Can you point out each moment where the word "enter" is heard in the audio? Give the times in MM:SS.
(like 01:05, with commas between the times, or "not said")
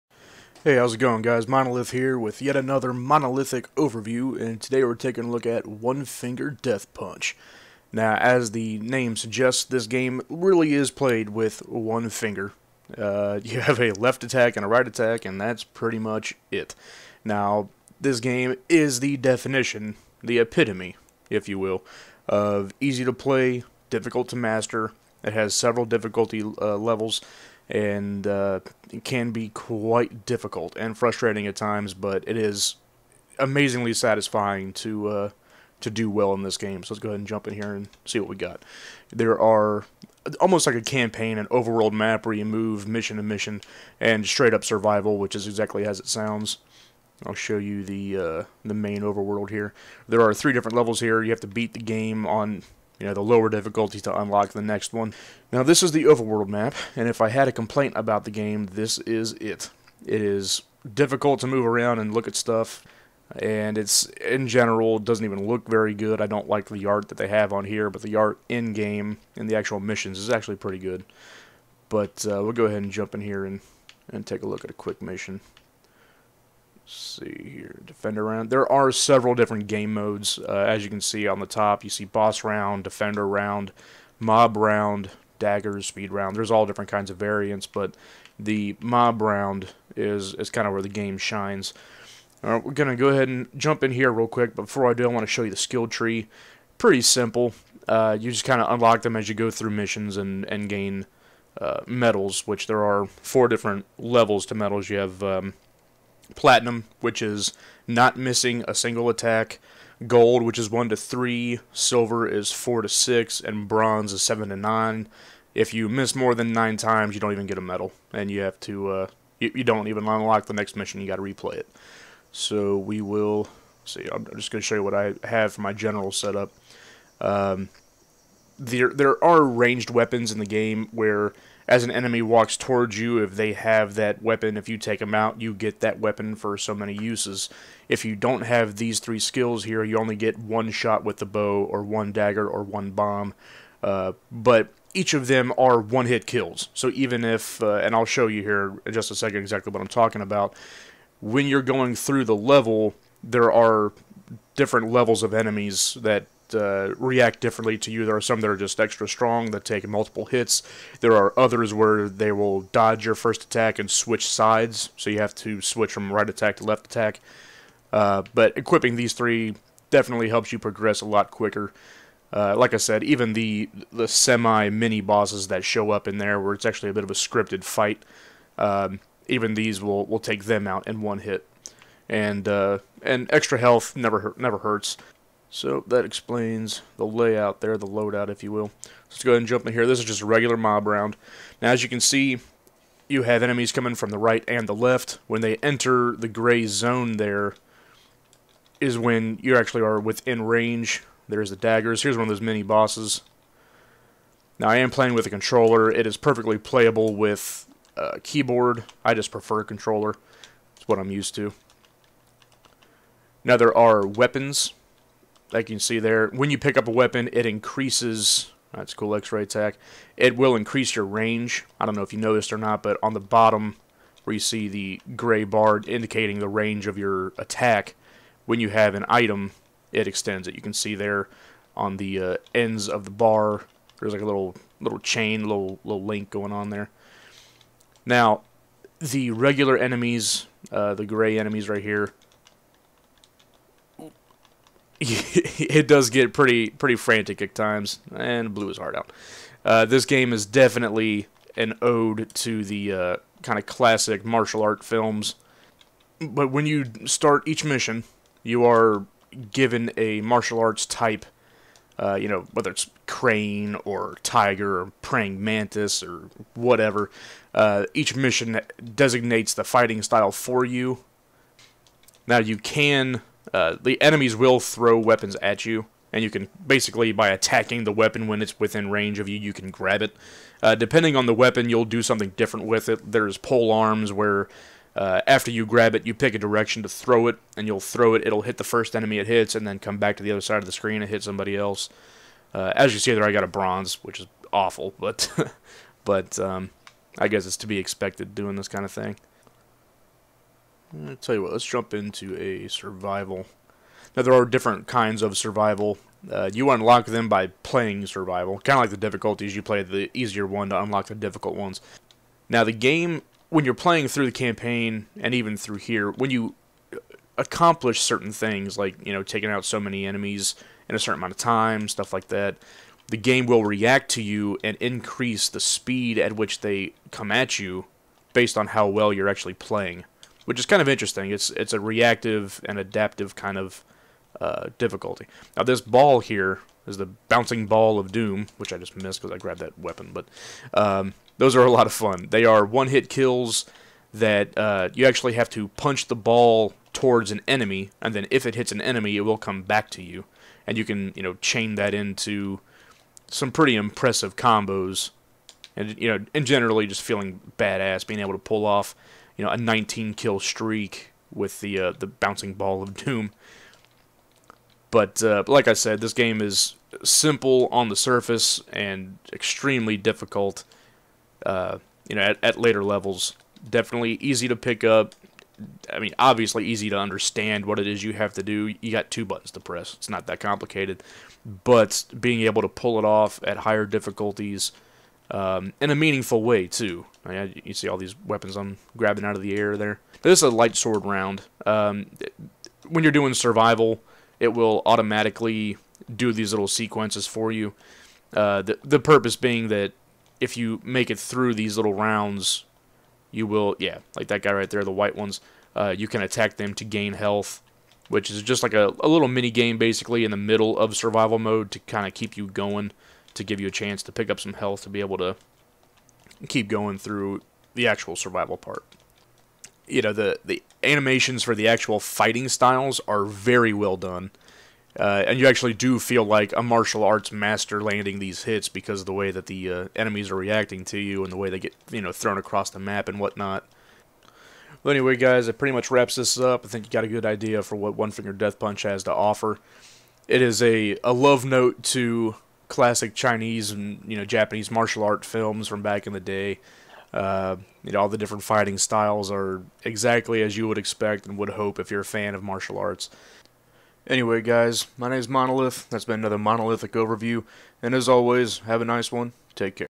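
03:15.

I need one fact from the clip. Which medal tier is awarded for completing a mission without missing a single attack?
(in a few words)
Platinum.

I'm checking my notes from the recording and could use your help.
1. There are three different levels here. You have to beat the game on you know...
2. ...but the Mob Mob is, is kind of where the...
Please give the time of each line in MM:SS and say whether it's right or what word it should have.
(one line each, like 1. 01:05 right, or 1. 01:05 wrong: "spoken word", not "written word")
1. 00:50 right
2. 01:27 wrong: "Round", not "Mob".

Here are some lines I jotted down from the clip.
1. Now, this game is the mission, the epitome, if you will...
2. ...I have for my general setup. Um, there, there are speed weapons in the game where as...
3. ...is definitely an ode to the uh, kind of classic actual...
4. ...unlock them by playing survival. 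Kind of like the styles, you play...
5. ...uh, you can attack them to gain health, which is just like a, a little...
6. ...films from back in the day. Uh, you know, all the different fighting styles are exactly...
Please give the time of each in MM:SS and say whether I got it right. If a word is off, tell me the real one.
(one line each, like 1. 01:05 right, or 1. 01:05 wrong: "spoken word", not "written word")
1. 00:17 wrong: "definition", not "mission"
2. 02:04 wrong: "ranged", not "speed"
3. 04:10 wrong: "martial", not "actual"
4. 05:06 wrong: "difficulties", not "styles"
5. 06:45 right
6. 07:25 right.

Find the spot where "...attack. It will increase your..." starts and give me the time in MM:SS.
03:39.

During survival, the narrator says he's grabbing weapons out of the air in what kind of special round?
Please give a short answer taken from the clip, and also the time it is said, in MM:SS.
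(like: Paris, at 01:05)
Light sword round, at 06:30.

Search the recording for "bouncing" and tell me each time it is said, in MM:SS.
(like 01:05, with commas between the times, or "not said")
05:37, 06:02.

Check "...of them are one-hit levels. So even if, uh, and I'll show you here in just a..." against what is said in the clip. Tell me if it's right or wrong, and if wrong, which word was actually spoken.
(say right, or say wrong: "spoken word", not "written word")
wrong: "kills", not "levels".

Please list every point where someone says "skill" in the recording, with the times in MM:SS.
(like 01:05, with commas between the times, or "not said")
01:35, 02:19.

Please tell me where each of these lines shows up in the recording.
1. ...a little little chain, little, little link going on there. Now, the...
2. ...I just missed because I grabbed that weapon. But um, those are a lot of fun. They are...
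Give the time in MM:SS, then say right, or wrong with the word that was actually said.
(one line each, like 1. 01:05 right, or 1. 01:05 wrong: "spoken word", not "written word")
1. 03:54 right
2. 05:38 right.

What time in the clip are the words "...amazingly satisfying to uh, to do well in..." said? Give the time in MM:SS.
00:33.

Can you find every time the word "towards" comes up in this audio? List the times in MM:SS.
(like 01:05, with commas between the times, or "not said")
02:12, 05:46.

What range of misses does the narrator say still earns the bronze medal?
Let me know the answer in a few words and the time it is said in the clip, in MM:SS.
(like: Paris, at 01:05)
7 to 9, at 01:54.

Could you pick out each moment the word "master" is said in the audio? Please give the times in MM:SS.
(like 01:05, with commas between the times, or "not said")
00:24, 07:07.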